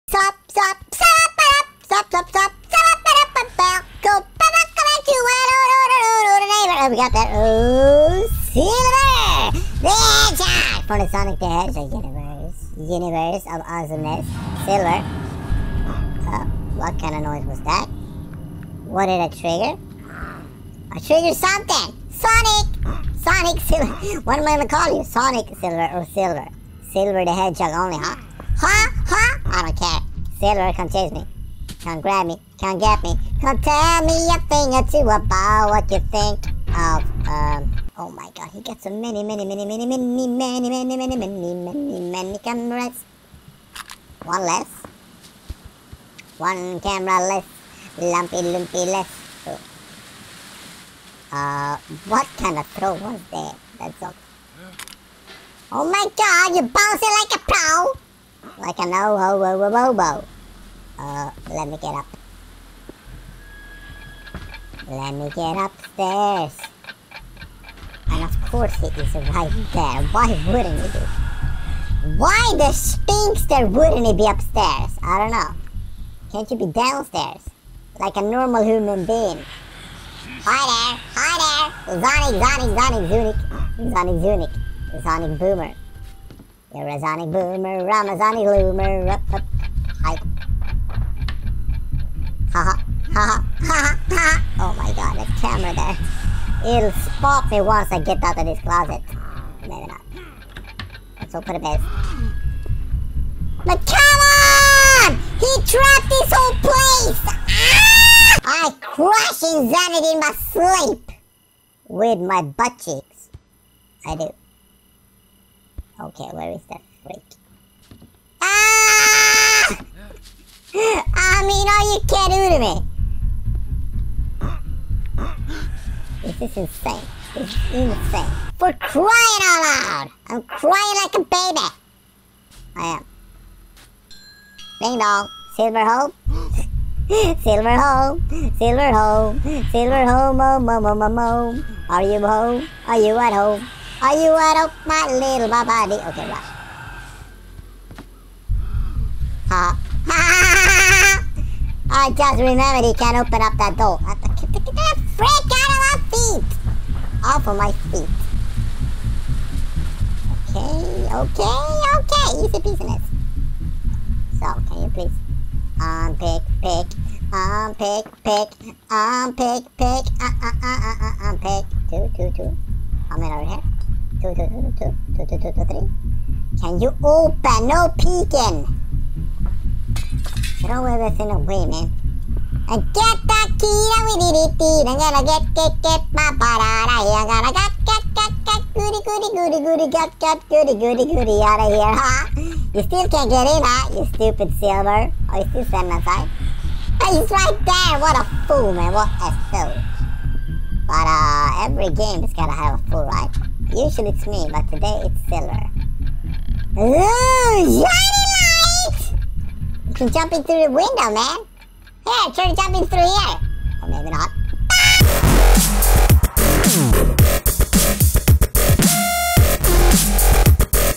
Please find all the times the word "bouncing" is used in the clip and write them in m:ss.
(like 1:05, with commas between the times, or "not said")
0:56.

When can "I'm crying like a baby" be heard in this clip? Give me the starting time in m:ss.
2:10.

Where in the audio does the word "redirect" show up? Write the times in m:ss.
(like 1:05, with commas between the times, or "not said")
not said.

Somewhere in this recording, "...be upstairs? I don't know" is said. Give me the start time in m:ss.
1:14.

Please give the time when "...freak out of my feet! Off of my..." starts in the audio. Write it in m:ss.
2:35.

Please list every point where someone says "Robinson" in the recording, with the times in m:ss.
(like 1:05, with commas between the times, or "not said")
not said.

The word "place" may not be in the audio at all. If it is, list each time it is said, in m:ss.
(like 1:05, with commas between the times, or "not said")
1:46.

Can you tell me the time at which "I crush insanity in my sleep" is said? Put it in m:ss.
1:48.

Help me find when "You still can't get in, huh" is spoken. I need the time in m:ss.
3:12.